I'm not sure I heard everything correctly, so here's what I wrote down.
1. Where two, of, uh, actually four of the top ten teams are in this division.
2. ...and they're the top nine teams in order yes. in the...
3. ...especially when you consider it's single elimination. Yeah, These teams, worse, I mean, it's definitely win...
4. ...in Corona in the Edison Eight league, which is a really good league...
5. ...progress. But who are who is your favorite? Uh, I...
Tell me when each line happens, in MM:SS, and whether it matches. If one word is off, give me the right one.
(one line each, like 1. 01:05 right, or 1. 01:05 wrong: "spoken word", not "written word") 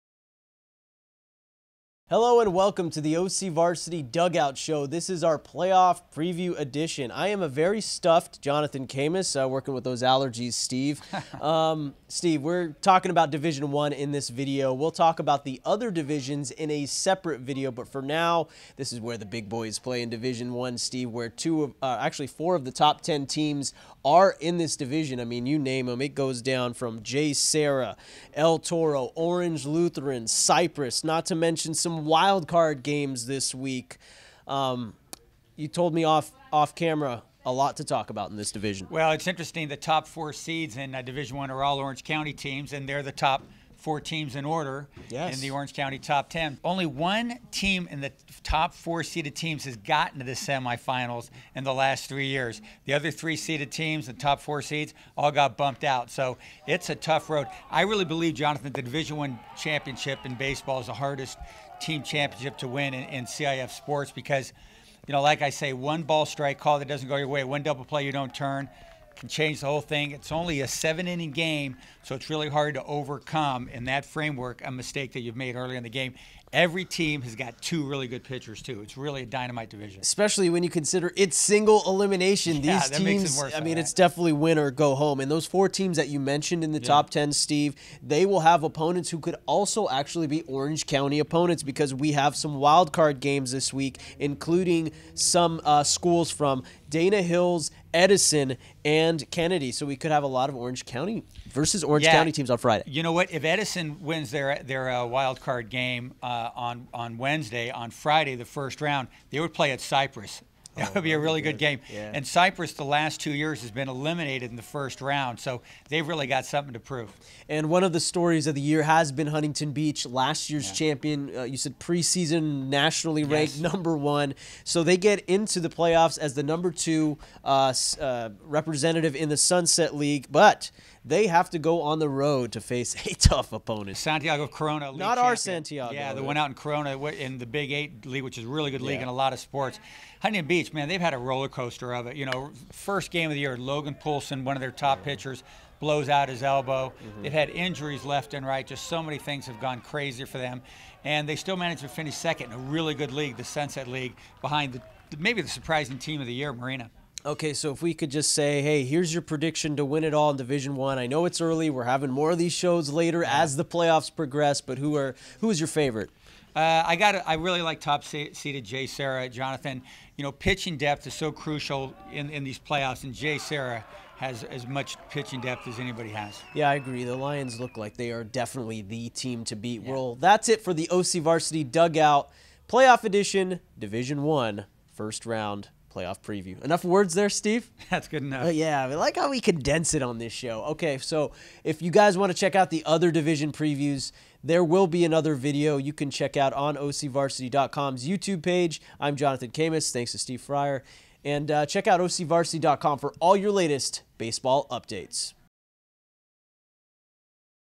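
1. 00:21 right
2. 00:42 wrong: "four", not "nine"
3. 01:20 right
4. 02:16 wrong: "Big", not "Edison"
5. 02:44 right.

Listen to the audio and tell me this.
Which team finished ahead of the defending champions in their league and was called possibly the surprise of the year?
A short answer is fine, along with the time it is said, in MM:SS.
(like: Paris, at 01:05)
Marina, at 02:36.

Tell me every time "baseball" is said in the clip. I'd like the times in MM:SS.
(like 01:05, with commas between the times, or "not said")
01:00, 03:24.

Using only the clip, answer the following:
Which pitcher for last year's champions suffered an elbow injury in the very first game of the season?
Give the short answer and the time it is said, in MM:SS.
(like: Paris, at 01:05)
Logan Poulsen, at 02:23.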